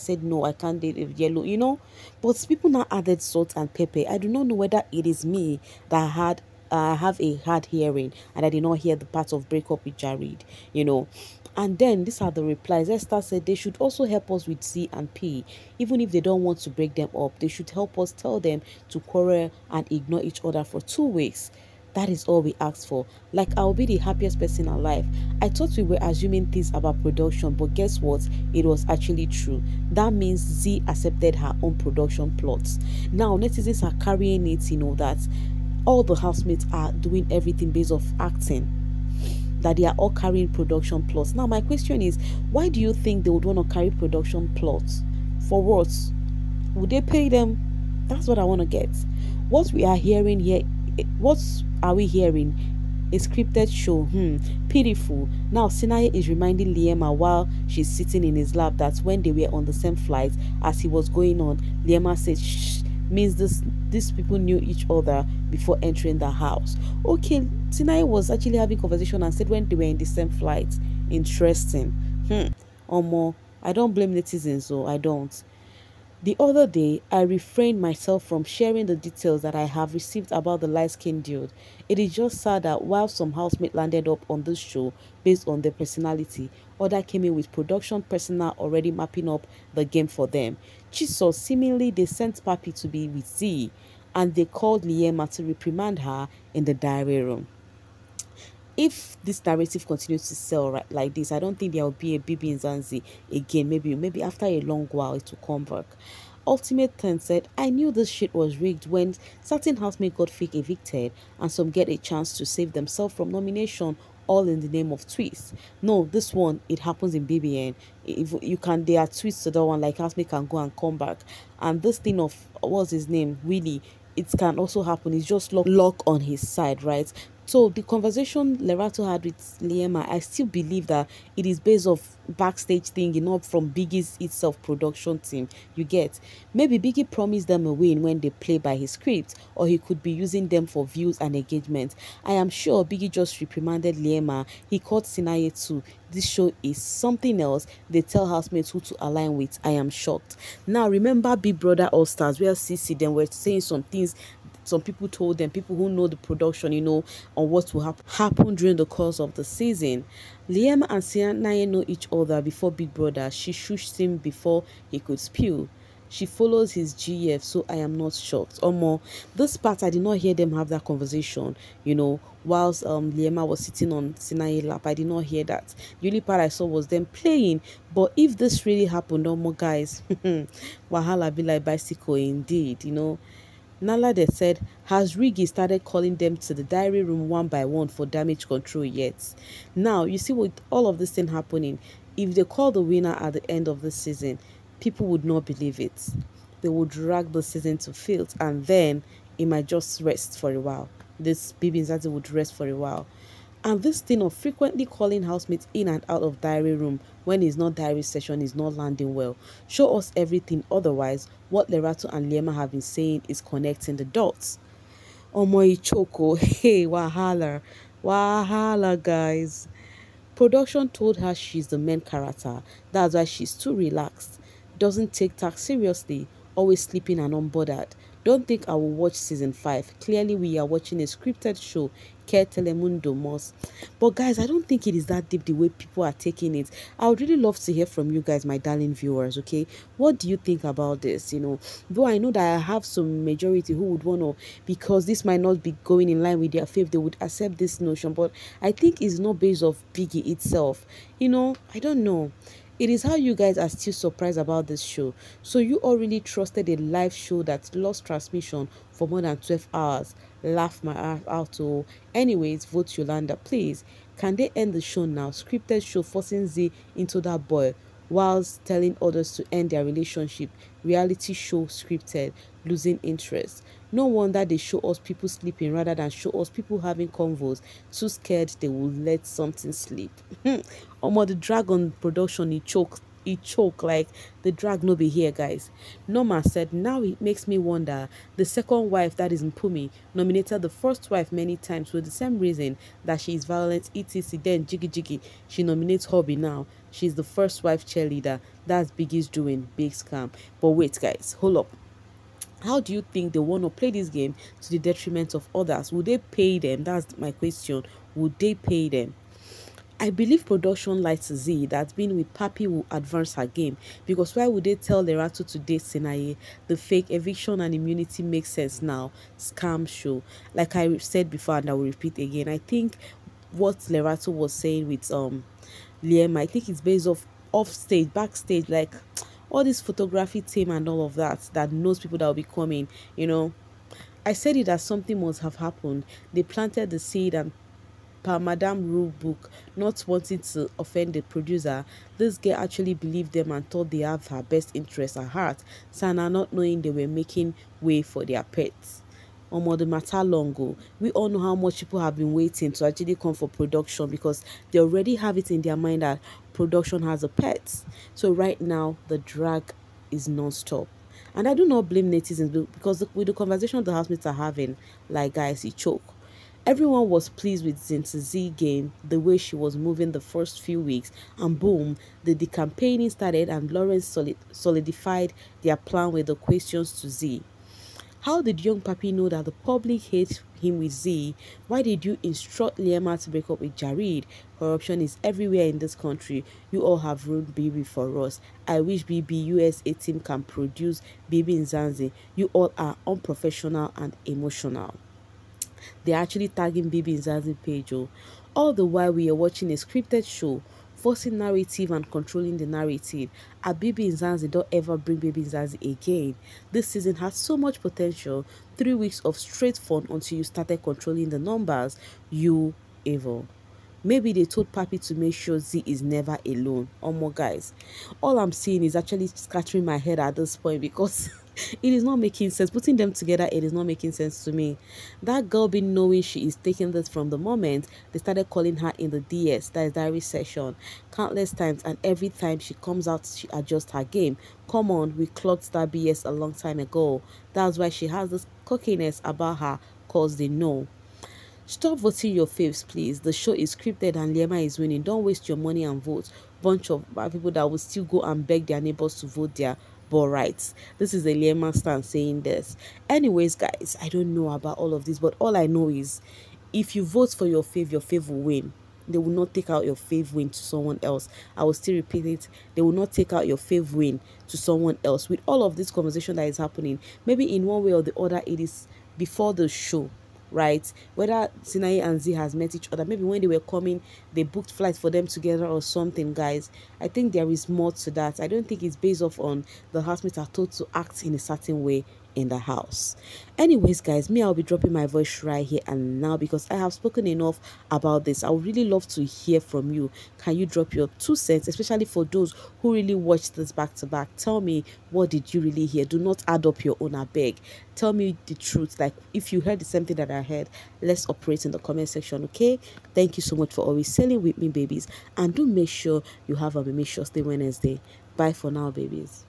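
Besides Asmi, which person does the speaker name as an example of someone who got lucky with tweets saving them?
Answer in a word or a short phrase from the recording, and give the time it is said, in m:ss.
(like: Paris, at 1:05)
Willie, at 2:03.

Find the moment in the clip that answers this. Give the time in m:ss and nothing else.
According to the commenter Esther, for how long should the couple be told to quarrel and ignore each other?
0:20.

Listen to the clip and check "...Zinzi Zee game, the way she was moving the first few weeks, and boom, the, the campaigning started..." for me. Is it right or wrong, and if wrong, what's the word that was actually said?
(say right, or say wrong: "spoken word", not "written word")
right.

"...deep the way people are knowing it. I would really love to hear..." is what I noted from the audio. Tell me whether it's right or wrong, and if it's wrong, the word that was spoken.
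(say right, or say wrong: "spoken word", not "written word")
wrong: "taking", not "knowing".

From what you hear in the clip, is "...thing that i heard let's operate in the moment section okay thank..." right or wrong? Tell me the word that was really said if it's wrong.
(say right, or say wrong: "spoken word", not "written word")
wrong: "comment", not "moment".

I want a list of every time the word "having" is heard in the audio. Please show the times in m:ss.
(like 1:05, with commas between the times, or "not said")
1:08, 4:36, 6:04.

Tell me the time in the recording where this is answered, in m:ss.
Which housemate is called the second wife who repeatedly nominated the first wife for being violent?
4:49.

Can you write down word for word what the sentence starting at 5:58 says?
So right now, the drag is non-stop.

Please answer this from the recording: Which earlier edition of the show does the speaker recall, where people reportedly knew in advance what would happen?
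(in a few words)
Big Brother All Stars.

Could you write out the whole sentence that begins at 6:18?
How did young Papi know that the public hates him with Zee?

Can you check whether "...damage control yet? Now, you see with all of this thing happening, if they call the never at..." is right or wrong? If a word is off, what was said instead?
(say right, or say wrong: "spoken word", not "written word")
wrong: "winner", not "never".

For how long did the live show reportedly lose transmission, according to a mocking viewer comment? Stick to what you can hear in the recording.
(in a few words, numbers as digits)
more than 12 hours.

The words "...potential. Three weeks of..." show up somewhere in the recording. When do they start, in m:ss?
6:47.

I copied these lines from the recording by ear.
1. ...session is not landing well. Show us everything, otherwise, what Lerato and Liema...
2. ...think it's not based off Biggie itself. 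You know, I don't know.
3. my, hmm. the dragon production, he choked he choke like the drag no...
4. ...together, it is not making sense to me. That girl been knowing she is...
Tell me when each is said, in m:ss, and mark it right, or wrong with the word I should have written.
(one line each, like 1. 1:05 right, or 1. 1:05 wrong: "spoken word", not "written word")
1. 3:28 right
2. 4:08 right
3. 4:40 right
4. 7:03 right.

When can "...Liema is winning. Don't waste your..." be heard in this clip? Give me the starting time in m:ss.
7:24.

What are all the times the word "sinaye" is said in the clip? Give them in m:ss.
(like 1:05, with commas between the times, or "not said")
0:55, 1:07, 2:25, 2:41, 2:54, 5:15, 7:51.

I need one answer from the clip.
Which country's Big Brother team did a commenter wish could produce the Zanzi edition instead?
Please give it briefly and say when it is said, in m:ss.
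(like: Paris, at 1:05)
USA, at 6:29.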